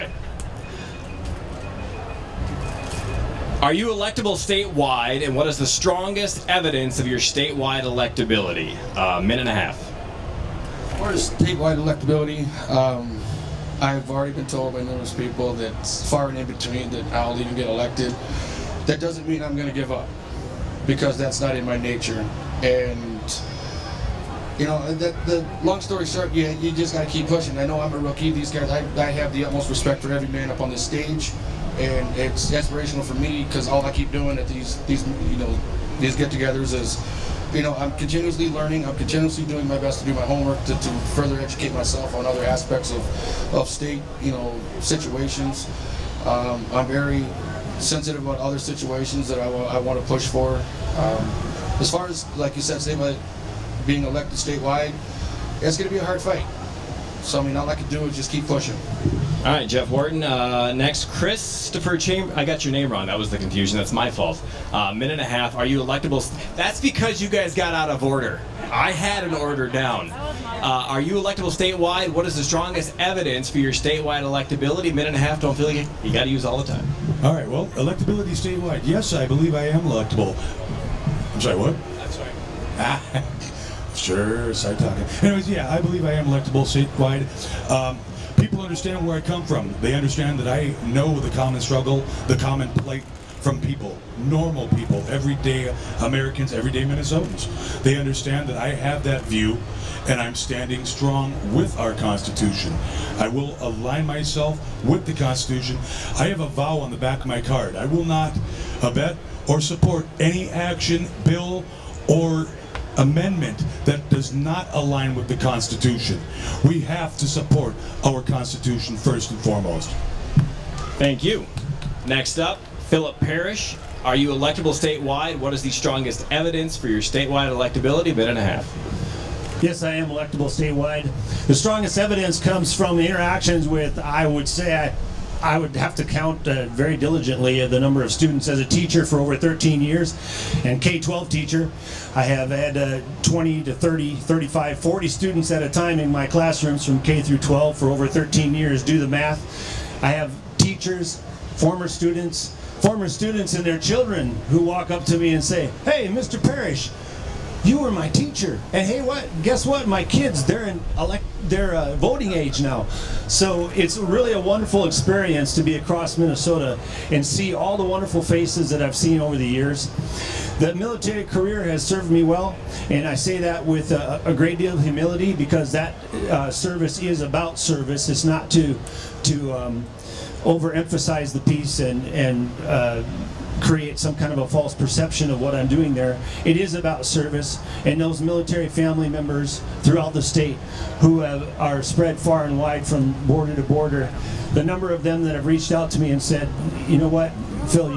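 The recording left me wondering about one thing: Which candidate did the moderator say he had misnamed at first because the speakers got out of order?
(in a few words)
Christopher Chamber.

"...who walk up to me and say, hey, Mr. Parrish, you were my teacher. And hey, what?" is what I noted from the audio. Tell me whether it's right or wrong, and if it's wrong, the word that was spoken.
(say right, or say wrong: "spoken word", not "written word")
right.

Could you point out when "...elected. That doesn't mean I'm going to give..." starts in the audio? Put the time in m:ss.
0:17.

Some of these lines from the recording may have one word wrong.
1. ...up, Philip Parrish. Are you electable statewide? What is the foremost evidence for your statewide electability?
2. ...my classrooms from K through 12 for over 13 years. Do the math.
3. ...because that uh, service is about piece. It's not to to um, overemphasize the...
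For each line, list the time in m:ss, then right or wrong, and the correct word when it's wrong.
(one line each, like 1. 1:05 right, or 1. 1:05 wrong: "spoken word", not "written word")
1. 2:02 wrong: "strongest", not "foremost"
2. 2:26 right
3. 2:55 wrong: "service", not "piece".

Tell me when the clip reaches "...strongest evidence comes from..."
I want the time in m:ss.
2:11.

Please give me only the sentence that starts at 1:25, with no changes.
Anyways, yeah, I believe I am electable statewide.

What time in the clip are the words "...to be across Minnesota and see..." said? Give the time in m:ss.
2:45.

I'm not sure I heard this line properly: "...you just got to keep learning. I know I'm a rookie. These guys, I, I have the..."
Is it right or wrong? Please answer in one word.
wrong.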